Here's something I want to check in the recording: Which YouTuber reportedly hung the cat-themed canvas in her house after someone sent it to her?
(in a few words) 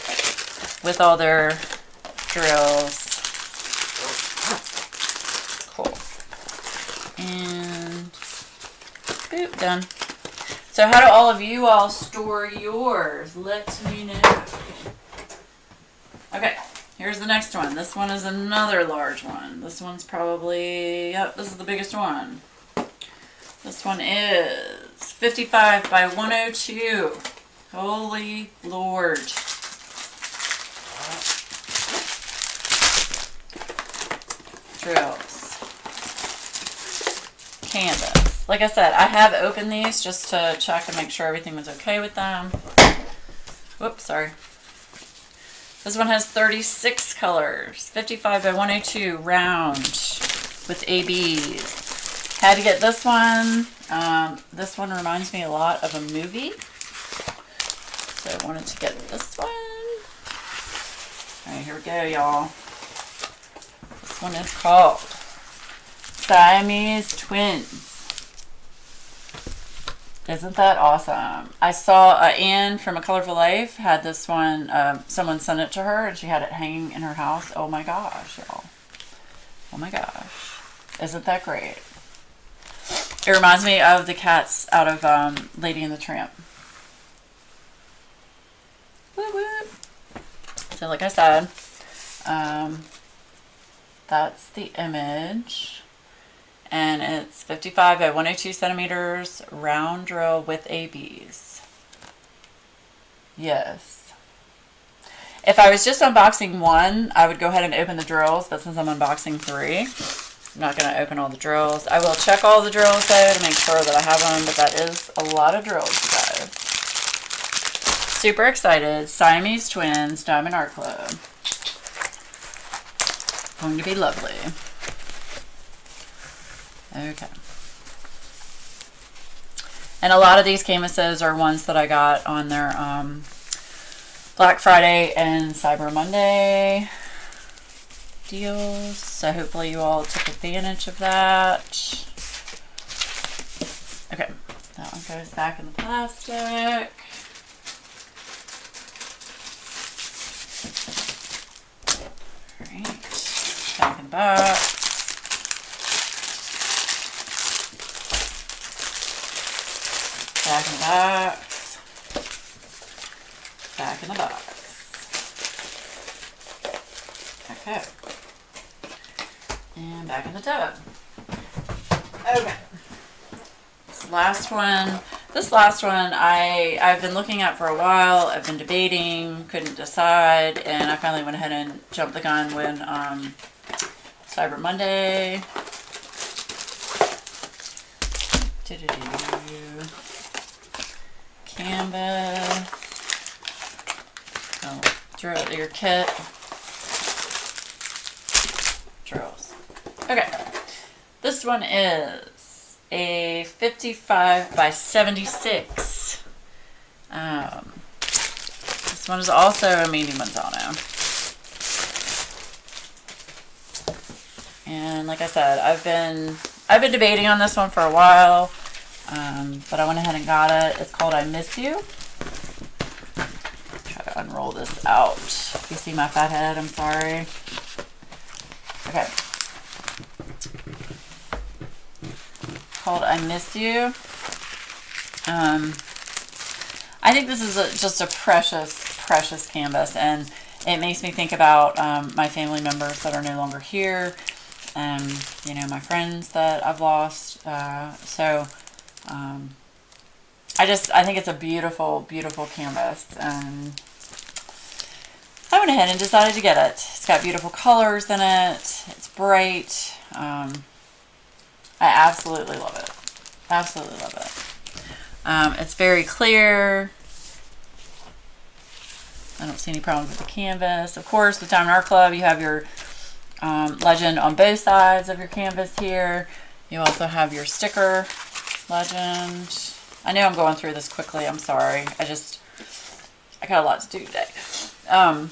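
Anne from A Colorful Life.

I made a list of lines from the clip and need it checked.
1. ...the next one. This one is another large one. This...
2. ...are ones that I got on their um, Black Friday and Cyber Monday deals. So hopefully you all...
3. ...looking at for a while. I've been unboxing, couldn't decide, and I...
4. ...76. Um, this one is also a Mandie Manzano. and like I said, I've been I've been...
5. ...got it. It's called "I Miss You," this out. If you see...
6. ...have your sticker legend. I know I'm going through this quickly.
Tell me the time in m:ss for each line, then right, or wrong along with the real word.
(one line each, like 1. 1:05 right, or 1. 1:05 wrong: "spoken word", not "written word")
1. 0:17 right
2. 2:11 right
3. 2:57 wrong: "debating", not "unboxing"
4. 3:24 right
5. 3:40 right
6. 4:37 right.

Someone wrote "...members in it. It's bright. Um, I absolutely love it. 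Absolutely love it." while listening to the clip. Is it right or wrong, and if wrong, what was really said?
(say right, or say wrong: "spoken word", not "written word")
wrong: "colors", not "members".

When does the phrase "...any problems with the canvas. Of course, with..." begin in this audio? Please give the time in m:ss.
4:29.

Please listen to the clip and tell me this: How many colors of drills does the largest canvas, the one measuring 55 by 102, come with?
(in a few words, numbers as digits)
36.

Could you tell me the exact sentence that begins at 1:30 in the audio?
So, like I said, um, that's the image and it's 55 by 102 centimeters round drill with ABs.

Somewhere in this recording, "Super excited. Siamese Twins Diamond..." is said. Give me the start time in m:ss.
1:58.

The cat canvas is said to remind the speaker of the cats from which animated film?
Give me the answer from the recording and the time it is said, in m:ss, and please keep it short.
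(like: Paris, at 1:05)
Lady and the Tramp, at 1:25.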